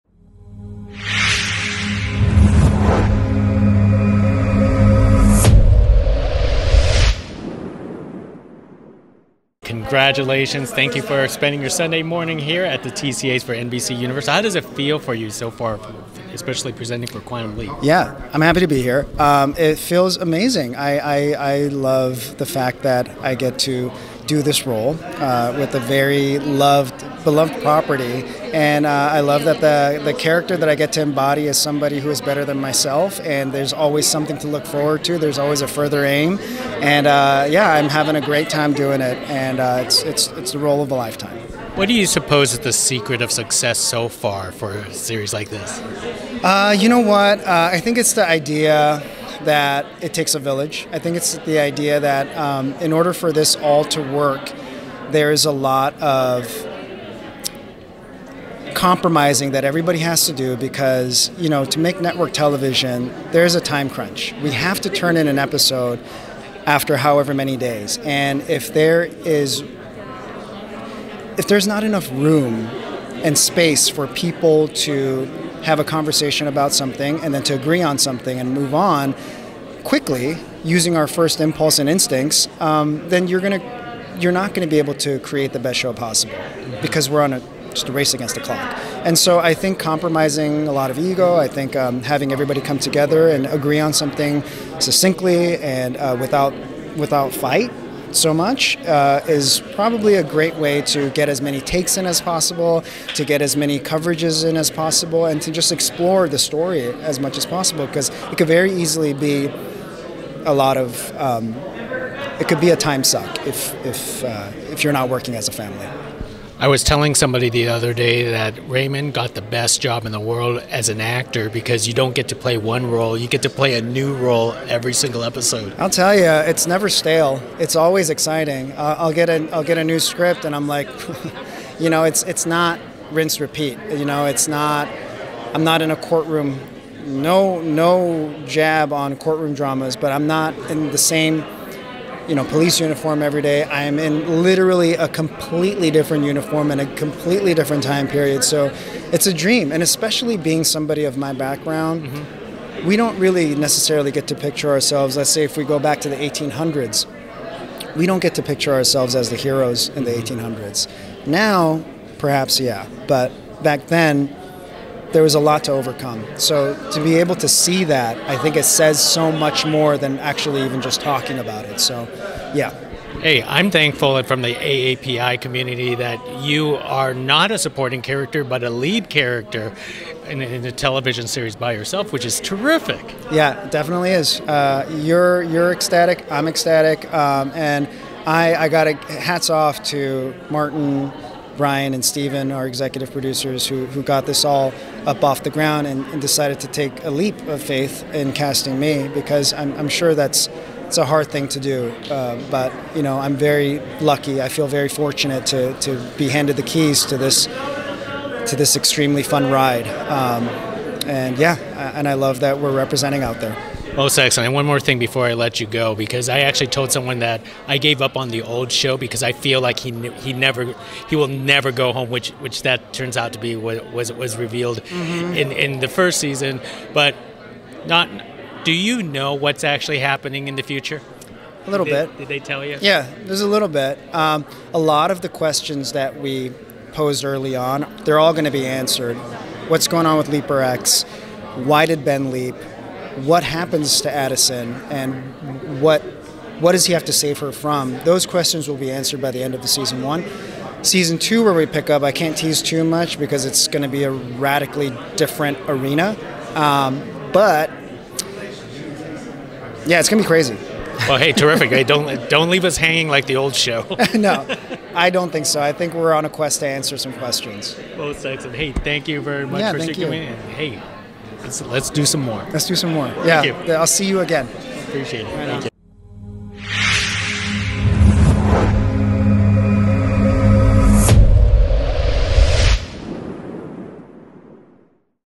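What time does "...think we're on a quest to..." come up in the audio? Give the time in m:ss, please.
4:25.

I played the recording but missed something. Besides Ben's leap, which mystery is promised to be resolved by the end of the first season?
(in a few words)
Leaper X.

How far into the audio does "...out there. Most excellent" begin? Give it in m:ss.
3:33.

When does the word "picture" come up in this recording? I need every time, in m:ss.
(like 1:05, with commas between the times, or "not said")
2:34, 2:38.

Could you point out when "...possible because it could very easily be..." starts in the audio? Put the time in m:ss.
1:47.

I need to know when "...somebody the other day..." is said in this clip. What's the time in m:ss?
1:57.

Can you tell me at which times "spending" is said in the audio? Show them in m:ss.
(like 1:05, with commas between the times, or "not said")
0:11.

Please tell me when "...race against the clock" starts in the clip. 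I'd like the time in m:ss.
1:27.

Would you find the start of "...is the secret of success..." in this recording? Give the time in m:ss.
0:42.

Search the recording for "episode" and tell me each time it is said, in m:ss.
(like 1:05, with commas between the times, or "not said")
1:05, 2:05.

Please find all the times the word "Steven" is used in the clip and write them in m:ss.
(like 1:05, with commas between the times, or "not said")
3:12.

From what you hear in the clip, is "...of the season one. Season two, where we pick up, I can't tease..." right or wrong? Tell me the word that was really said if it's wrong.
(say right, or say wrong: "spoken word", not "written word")
right.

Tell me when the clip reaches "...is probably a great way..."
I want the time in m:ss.
1:39.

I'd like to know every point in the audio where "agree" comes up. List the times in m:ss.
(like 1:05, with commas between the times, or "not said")
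1:17, 1:33.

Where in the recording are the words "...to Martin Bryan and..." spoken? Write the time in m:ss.
3:09.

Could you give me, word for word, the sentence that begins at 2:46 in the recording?
So to be able to see that, I think it says so much more than actually even just talking about it.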